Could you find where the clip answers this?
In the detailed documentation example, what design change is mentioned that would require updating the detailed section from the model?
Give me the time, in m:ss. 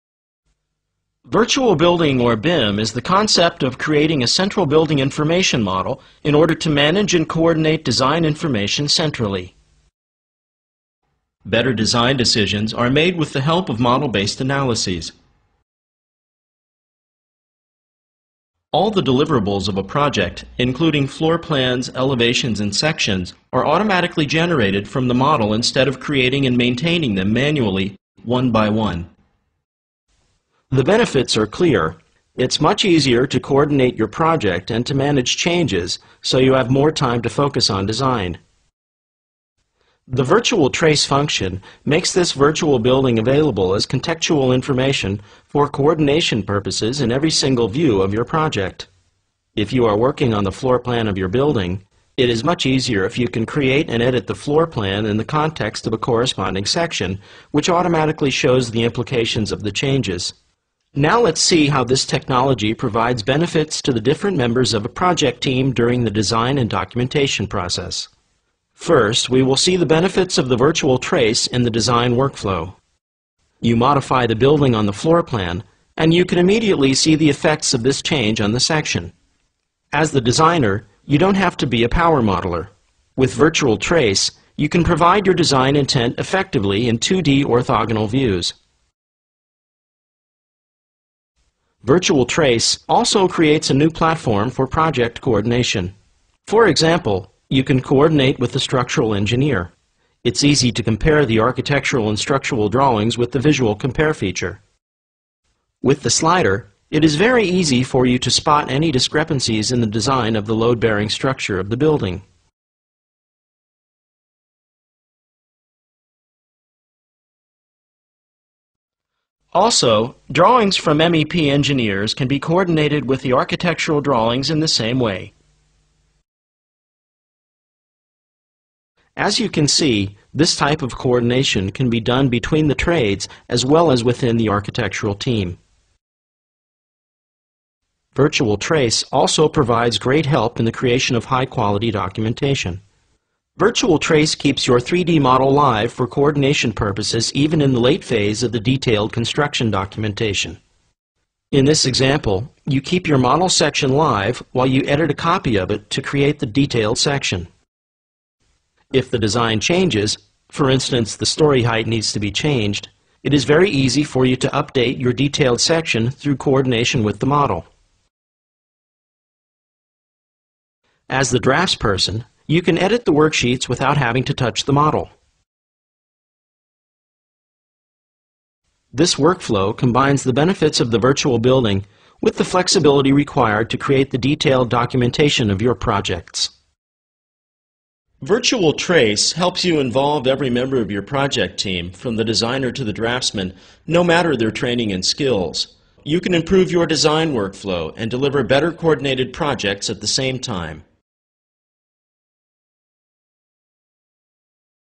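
2:41.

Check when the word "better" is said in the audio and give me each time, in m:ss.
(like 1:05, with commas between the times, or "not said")
0:11, 3:18.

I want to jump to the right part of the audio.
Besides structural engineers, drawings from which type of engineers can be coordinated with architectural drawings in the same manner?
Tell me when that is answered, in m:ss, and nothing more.
2:00.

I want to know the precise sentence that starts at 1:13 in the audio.
You modify the building on the floor plan, and you can immediately see the effects of this change on the section.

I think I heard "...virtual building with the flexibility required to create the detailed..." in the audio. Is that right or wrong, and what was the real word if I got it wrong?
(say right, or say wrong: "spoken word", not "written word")
right.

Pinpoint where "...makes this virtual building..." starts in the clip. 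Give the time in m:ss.
0:41.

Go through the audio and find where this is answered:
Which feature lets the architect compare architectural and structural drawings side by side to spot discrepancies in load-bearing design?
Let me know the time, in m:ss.
1:43.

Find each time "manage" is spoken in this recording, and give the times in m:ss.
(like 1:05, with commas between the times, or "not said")
0:06, 0:34.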